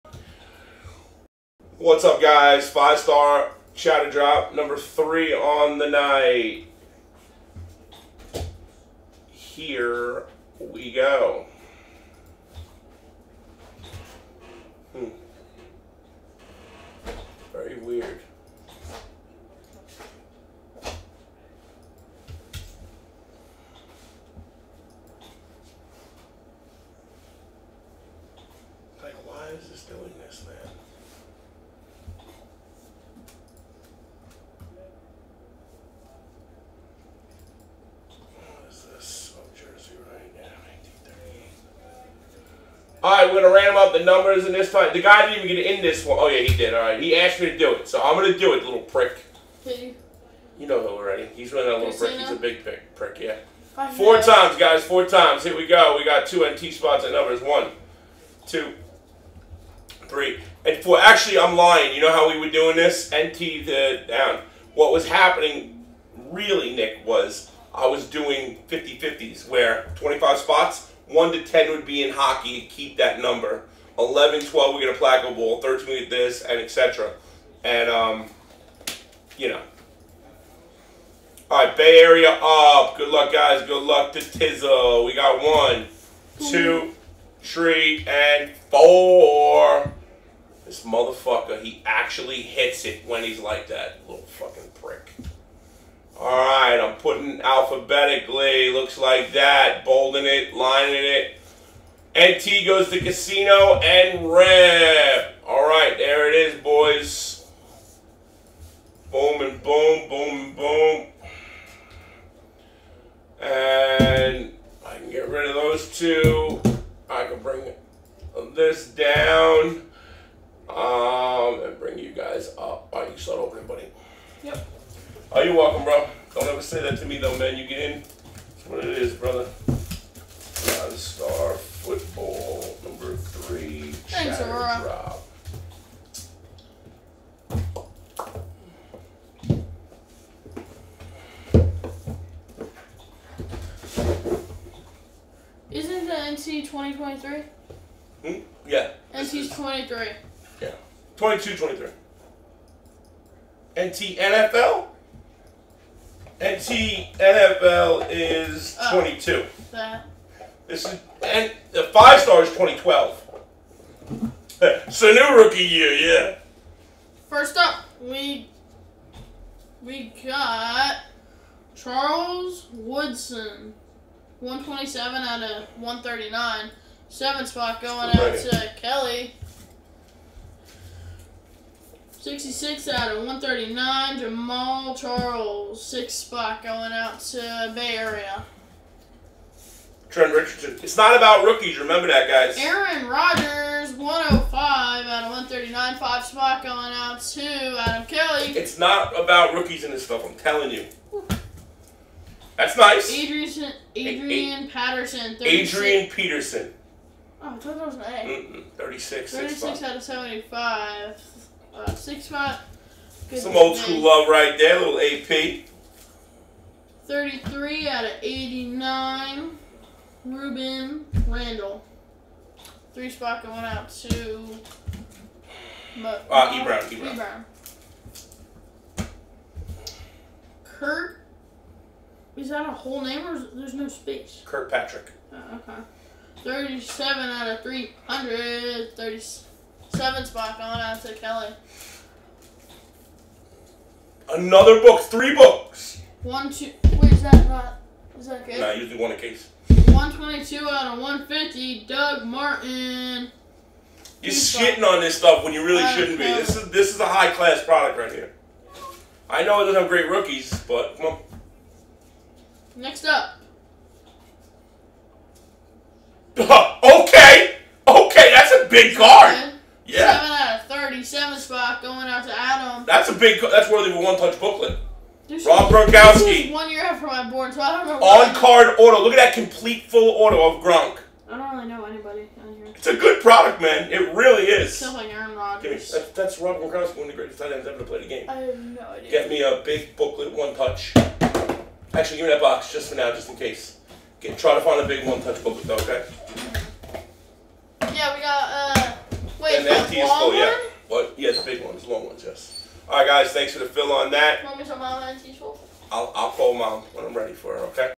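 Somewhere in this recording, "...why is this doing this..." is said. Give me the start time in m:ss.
0:29.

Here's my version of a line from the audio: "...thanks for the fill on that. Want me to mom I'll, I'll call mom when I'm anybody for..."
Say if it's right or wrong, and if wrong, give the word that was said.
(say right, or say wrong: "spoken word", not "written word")
wrong: "ready", not "anybody".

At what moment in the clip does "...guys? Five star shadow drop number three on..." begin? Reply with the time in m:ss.
0:02.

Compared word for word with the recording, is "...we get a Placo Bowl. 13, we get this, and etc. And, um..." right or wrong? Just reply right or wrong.
right.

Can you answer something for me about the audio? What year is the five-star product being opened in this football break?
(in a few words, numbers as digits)
2012.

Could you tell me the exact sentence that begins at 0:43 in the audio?
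All right, we're gonna random up the numbers, in this fight.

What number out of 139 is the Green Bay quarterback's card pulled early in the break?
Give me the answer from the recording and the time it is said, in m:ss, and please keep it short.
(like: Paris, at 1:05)
105, at 3:13.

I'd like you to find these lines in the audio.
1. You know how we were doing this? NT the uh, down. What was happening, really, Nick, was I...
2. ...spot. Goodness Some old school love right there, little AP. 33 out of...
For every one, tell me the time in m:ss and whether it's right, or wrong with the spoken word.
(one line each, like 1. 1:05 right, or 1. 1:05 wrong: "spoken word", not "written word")
1. 1:01 right
2. 3:32 right.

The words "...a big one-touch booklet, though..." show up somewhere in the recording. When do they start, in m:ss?
4:54.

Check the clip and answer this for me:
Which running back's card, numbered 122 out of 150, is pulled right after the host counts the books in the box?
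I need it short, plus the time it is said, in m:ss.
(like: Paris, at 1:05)
Doug Martin, at 4:11.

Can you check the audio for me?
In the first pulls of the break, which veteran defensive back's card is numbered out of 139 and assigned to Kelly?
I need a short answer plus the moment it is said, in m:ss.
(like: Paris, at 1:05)
Charles Woodson, at 2:51.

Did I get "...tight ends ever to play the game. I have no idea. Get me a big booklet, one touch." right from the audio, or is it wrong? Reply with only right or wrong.
right.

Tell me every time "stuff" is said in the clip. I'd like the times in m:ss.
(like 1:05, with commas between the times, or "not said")
3:20, 4:15.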